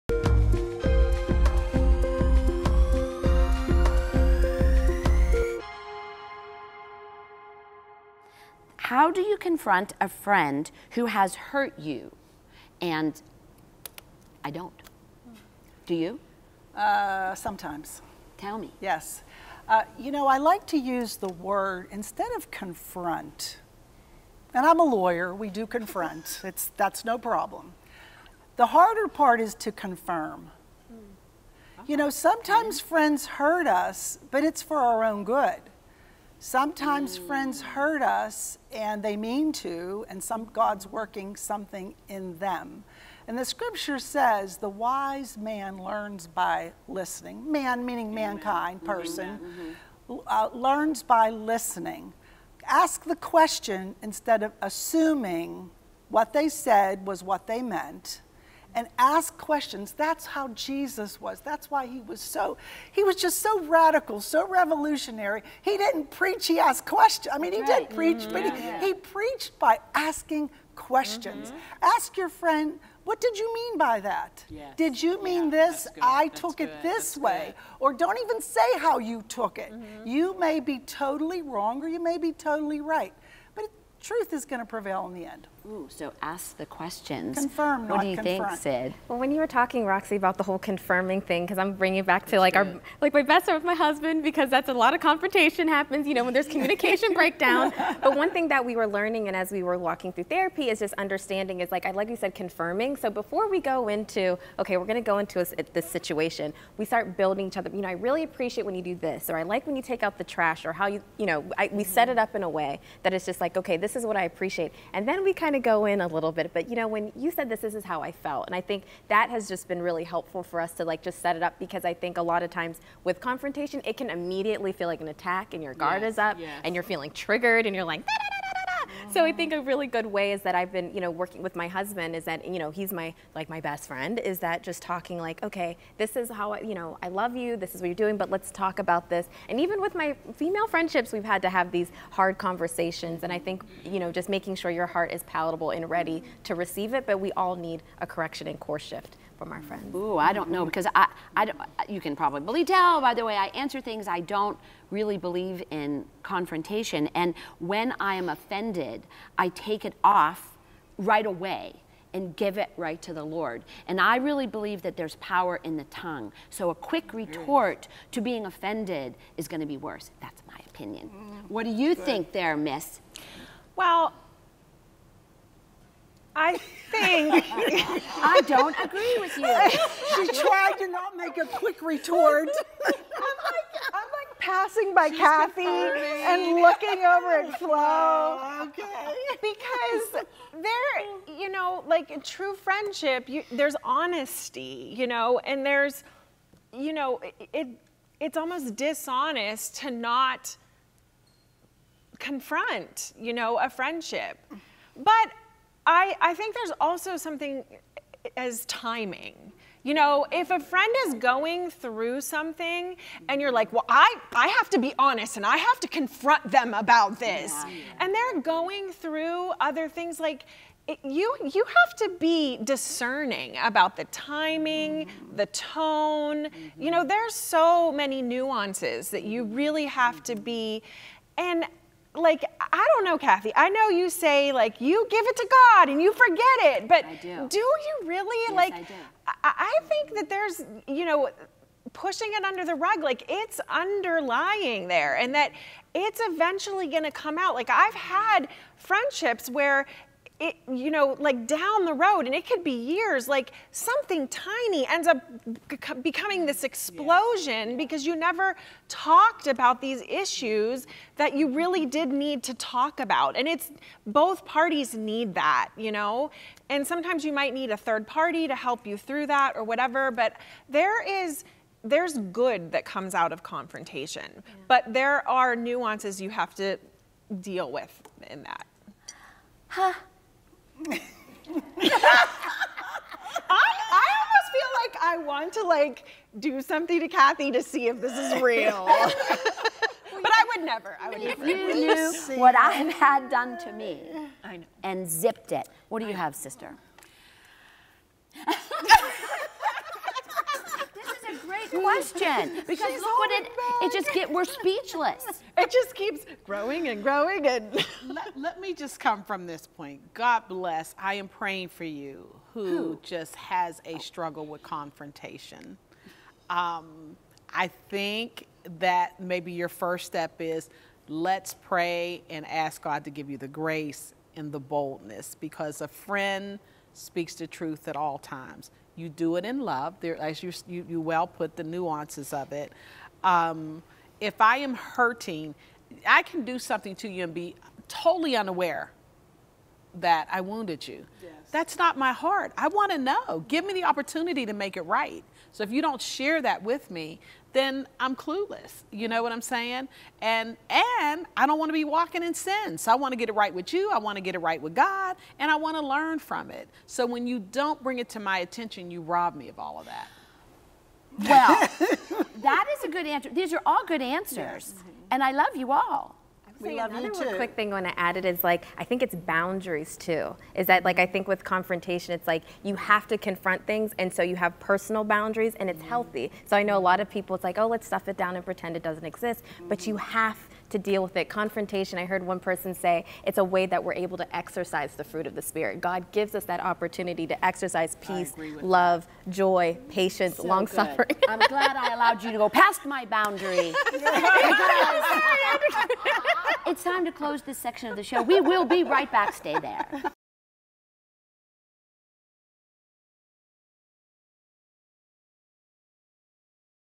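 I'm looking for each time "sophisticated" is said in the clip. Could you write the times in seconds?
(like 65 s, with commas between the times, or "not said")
not said.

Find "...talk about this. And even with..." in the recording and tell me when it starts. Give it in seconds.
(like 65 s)
138 s.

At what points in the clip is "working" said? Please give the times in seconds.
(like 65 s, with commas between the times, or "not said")
40 s, 131 s.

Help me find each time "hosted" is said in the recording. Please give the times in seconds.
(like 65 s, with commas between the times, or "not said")
not said.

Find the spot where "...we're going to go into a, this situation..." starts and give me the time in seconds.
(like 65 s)
104 s.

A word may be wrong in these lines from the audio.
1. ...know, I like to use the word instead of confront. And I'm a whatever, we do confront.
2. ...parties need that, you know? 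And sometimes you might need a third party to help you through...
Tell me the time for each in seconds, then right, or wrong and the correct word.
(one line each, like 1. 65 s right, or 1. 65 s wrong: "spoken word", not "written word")
1. 20 s wrong: "lawyer", not "whatever"
2. 264 s right.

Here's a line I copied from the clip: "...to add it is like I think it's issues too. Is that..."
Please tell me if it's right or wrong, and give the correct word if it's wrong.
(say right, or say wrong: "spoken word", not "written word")
wrong: "boundaries", not "issues".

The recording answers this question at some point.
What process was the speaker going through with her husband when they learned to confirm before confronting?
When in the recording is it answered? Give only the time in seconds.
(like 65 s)
100 s.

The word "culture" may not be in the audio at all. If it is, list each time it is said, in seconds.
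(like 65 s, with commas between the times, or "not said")
not said.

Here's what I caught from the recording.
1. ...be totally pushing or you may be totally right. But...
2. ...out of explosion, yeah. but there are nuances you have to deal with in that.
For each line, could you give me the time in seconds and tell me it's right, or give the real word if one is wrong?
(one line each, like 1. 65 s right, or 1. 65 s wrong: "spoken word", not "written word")
1. 80 s wrong: "wrong", not "pushing"
2. 273 s wrong: "confrontation", not "explosion".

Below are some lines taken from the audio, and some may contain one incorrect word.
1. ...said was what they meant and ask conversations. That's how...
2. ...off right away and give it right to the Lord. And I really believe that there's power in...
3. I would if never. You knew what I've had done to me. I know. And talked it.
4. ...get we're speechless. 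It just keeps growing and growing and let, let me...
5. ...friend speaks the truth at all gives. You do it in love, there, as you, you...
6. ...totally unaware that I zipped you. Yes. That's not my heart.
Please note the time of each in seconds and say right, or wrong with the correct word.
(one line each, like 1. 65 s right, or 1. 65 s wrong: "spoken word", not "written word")
1. 56 s wrong: "questions", not "conversations"
2. 160 s right
3. 291 s wrong: "zipped", not "talked"
4. 304 s right
5. 325 s wrong: "times", not "gives"
6. 337 s wrong: "wounded", not "zipped".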